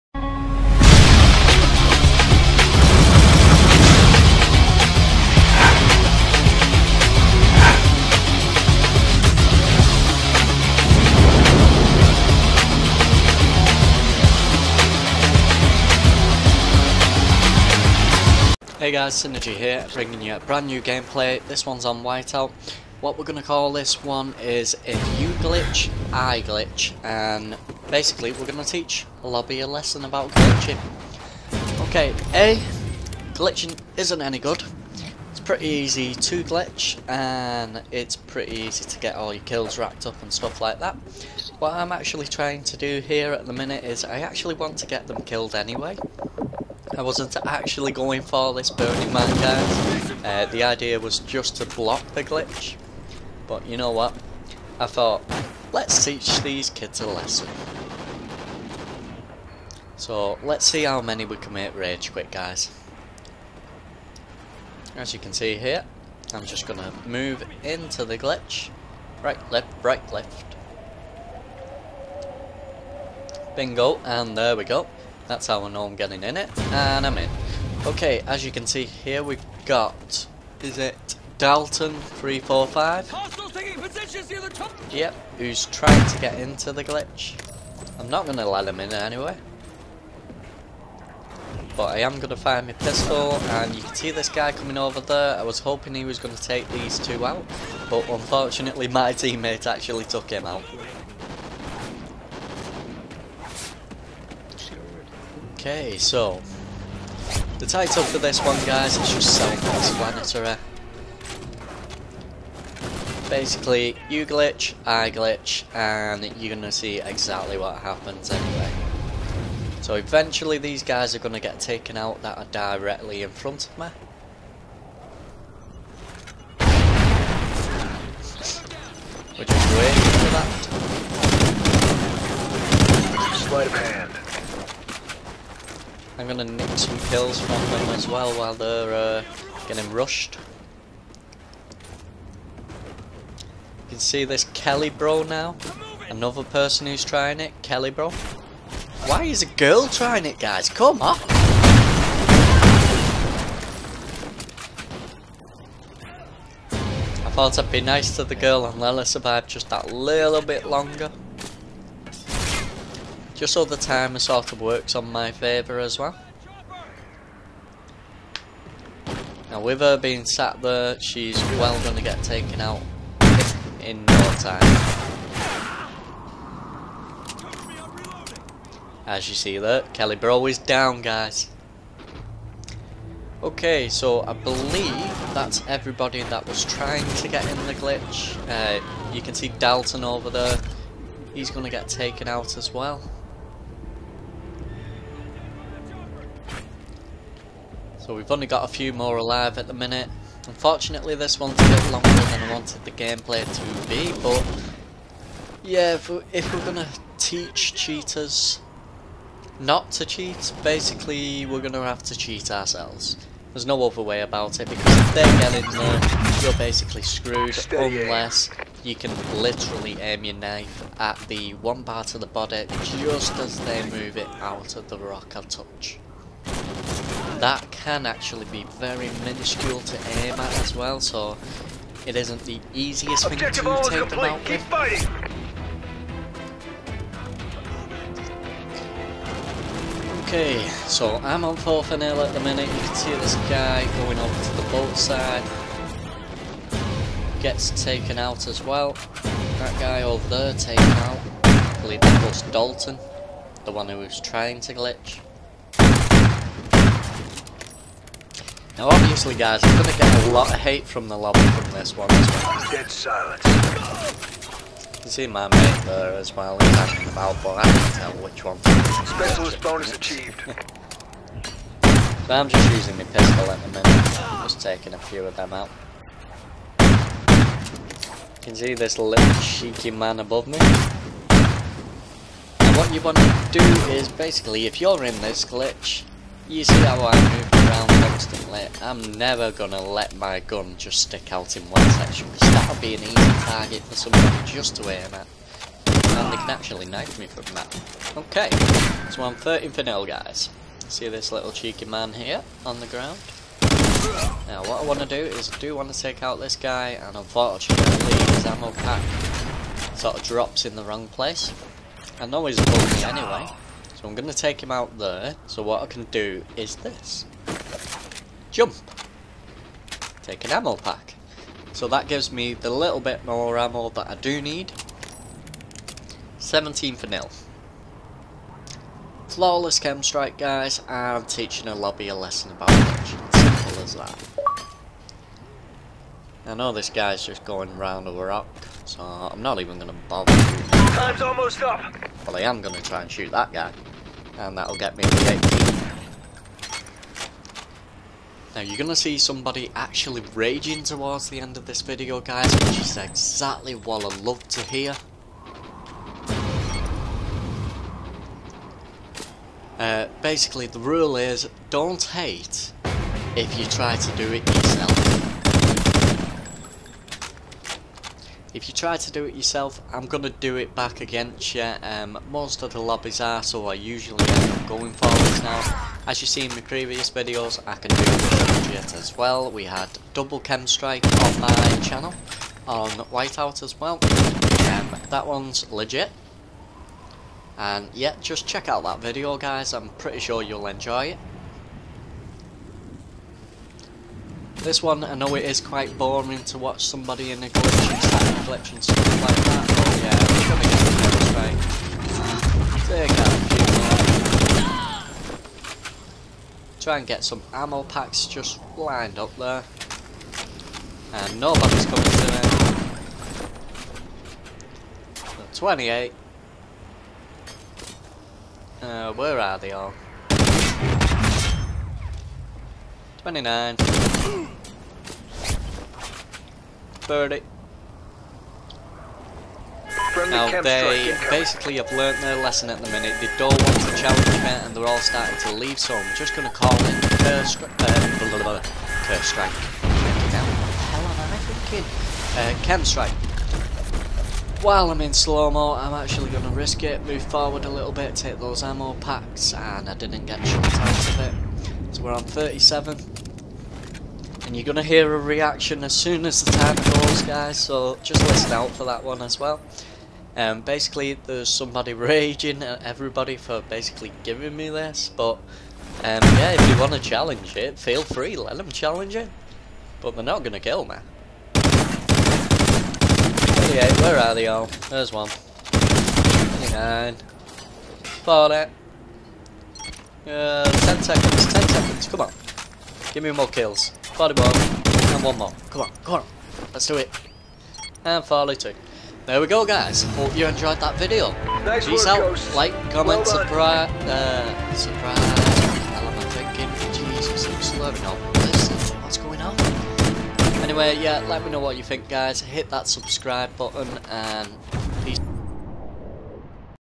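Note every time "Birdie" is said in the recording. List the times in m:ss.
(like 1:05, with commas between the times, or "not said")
7:07.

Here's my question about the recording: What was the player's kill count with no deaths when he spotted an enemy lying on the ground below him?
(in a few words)
13.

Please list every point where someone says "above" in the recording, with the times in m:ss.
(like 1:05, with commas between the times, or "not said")
4:40, 5:12.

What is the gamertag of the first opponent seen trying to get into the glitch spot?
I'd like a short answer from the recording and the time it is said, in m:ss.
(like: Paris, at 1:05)
Dalton345, at 1:21.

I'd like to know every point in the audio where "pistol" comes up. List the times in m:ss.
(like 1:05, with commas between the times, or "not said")
1:32, 4:33.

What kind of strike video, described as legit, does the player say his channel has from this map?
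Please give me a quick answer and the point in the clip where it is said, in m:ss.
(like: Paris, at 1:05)
double KEM strike, at 6:20.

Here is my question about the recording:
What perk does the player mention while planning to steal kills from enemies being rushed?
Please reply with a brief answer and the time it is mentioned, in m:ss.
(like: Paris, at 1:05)
Sleight of hand, at 2:13.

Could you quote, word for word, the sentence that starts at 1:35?
I was hoping he was going to take these two out, but unfortunately my teammate actually took him out.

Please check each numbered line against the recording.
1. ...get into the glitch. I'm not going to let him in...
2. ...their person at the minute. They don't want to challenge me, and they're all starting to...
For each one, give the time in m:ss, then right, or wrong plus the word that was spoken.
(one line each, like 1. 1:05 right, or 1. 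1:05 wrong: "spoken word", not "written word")
1. 1:26 right
2. 7:12 wrong: "lesson", not "person".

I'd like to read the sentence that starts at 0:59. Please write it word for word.
So, let's see how many we can make rage quit, guys.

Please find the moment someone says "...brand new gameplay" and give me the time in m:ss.
0:20.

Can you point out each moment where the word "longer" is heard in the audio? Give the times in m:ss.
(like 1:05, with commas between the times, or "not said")
2:40, 3:21.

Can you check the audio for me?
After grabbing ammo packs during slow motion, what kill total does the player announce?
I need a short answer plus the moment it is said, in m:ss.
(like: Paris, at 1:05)
37, at 7:32.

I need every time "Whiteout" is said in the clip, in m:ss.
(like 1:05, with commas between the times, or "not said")
0:22, 6:22.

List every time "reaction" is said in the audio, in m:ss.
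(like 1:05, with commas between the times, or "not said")
7:35.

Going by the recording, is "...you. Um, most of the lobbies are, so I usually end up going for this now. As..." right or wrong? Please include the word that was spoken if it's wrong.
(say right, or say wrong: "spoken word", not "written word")
right.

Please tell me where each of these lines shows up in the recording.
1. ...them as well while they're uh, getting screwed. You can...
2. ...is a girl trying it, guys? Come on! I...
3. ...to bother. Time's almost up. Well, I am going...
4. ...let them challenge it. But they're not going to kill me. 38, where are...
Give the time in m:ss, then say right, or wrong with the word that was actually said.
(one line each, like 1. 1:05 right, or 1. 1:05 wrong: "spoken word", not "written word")
1. 2:17 wrong: "rushed", not "screwed"
2. 2:29 right
3. 5:39 right
4. 7:48 right.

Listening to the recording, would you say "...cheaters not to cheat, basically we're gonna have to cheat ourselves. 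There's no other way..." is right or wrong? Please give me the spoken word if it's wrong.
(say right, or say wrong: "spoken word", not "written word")
right.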